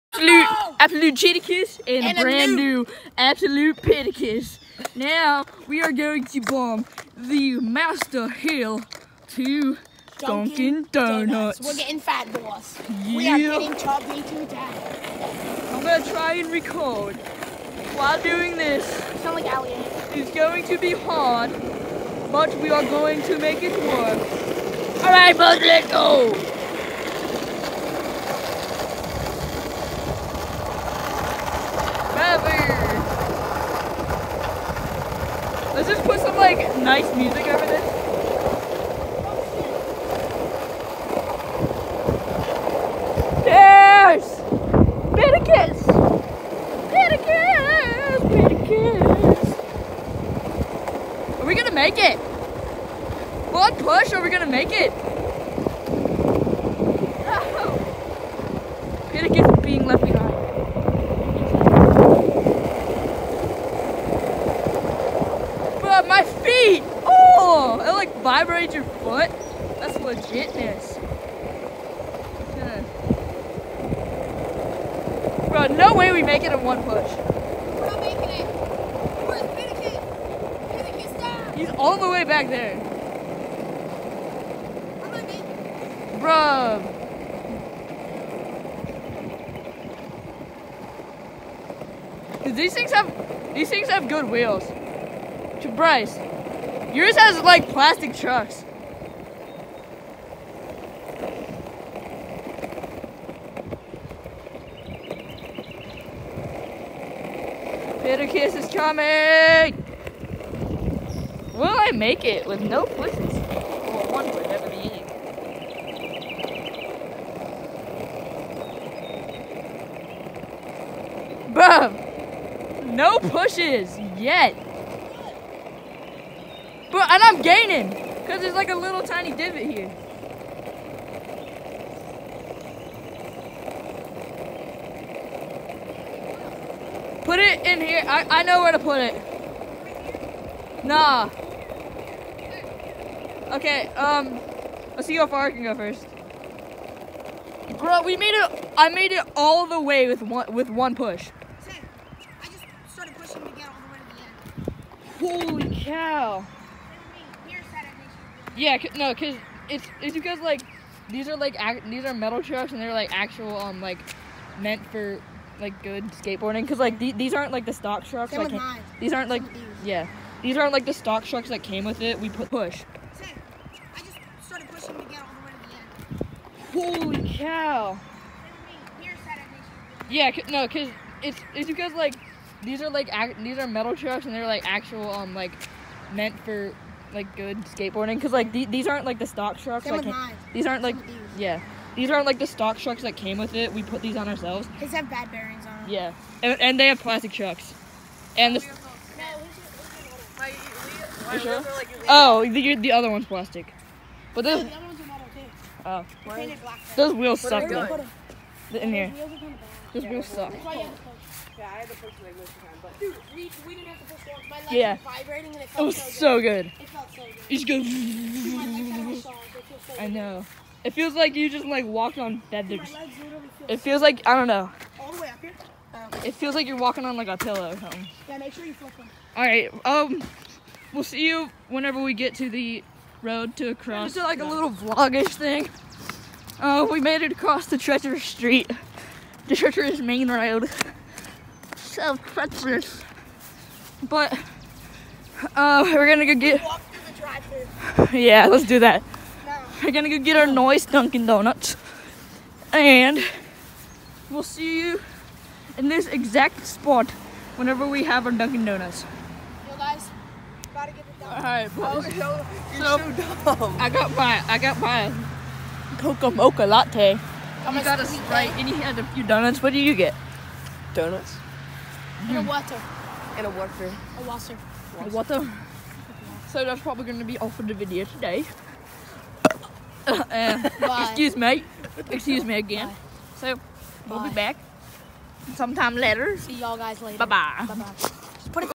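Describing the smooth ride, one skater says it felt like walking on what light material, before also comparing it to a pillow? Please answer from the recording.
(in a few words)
Feathers.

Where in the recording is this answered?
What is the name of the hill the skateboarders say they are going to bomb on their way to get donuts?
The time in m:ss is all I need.
0:07.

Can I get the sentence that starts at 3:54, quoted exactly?
just like a little vlogish thing.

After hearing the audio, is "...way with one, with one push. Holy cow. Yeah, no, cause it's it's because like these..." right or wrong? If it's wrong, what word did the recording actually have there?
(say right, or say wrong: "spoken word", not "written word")
right.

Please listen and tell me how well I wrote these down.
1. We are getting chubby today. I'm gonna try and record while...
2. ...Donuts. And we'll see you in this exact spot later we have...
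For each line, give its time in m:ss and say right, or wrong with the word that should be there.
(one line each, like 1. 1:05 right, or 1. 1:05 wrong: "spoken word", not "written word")
1. 0:13 right
2. 4:11 wrong: "whenever", not "later".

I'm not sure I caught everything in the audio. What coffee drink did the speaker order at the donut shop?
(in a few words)
Coca Mocha latte.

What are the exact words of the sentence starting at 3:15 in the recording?
Yeah, and, and they have plastic trucks, and the.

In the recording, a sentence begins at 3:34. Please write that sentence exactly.
was vibrating and it felt it was so good.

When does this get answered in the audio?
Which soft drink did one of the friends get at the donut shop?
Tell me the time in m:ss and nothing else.
4:28.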